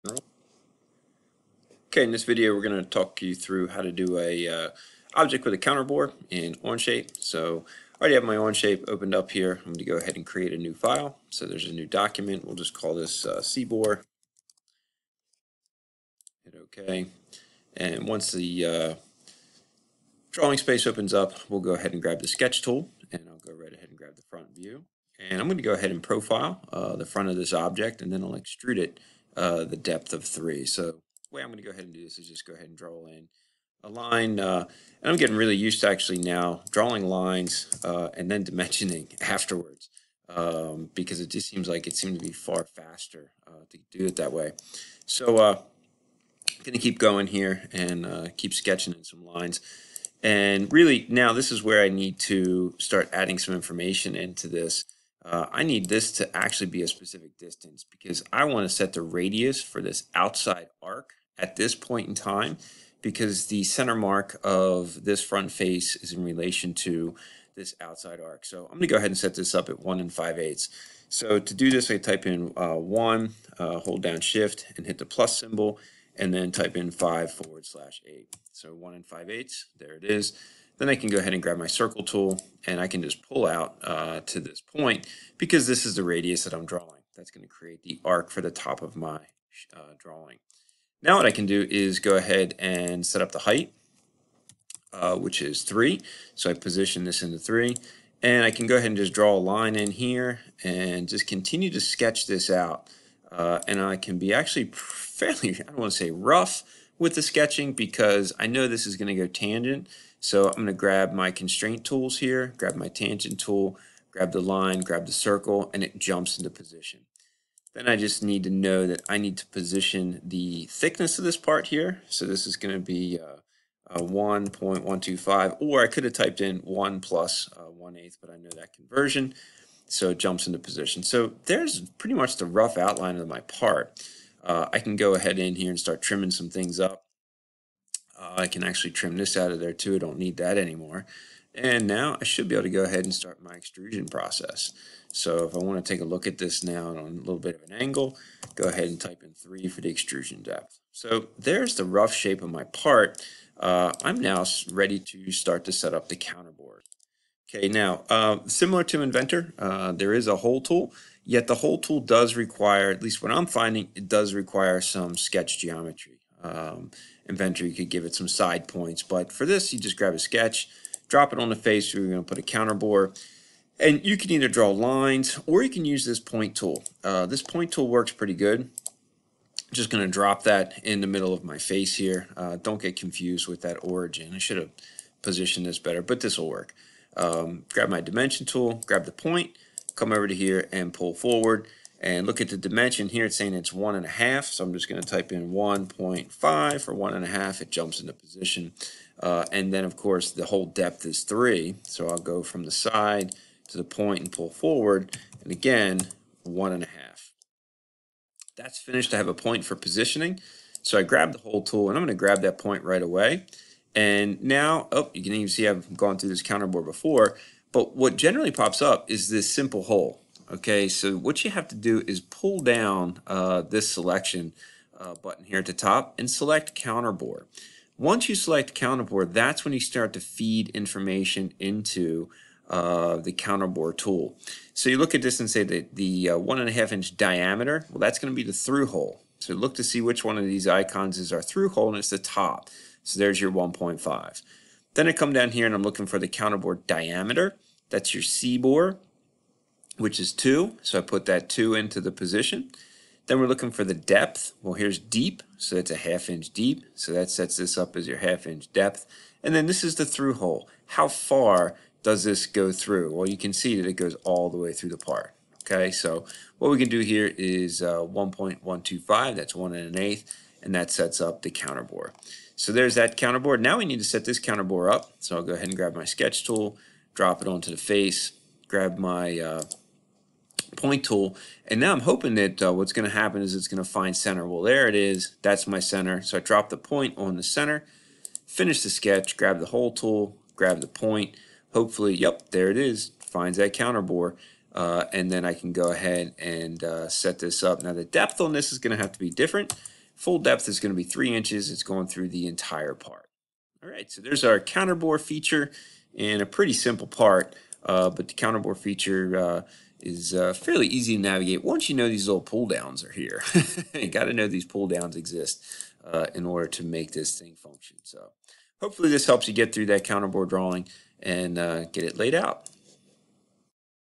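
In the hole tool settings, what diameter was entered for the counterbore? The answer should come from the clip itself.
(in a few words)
2.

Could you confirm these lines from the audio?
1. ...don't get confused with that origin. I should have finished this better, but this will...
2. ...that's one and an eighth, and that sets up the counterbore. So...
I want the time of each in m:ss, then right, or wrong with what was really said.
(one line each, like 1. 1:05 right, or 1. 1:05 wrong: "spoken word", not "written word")
1. 3:02 wrong: "positioned", not "finished"
2. 4:29 right.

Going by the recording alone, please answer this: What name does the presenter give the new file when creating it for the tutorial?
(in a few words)
CBOR.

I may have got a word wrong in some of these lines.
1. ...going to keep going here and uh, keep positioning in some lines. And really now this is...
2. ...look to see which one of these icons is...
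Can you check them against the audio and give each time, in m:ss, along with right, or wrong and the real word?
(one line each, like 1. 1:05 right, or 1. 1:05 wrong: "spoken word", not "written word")
1. 0:46 wrong: "sketching", not "positioning"
2. 3:59 right.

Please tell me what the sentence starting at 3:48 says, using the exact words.
Once you select counterbore, that's when you start to feed information into uh, the counterbore tool.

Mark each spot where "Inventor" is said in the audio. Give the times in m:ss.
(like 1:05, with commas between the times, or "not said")
2:39, 2:47.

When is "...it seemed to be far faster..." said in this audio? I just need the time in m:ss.
0:41.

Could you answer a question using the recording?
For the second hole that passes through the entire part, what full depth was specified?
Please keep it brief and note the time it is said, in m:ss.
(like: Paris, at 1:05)
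3 inches, at 5:01.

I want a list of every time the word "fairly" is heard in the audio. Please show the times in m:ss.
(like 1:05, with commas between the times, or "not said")
1:44, 5:10.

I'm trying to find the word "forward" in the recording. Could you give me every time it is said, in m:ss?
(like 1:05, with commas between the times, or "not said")
1:17, 3:11, 3:24.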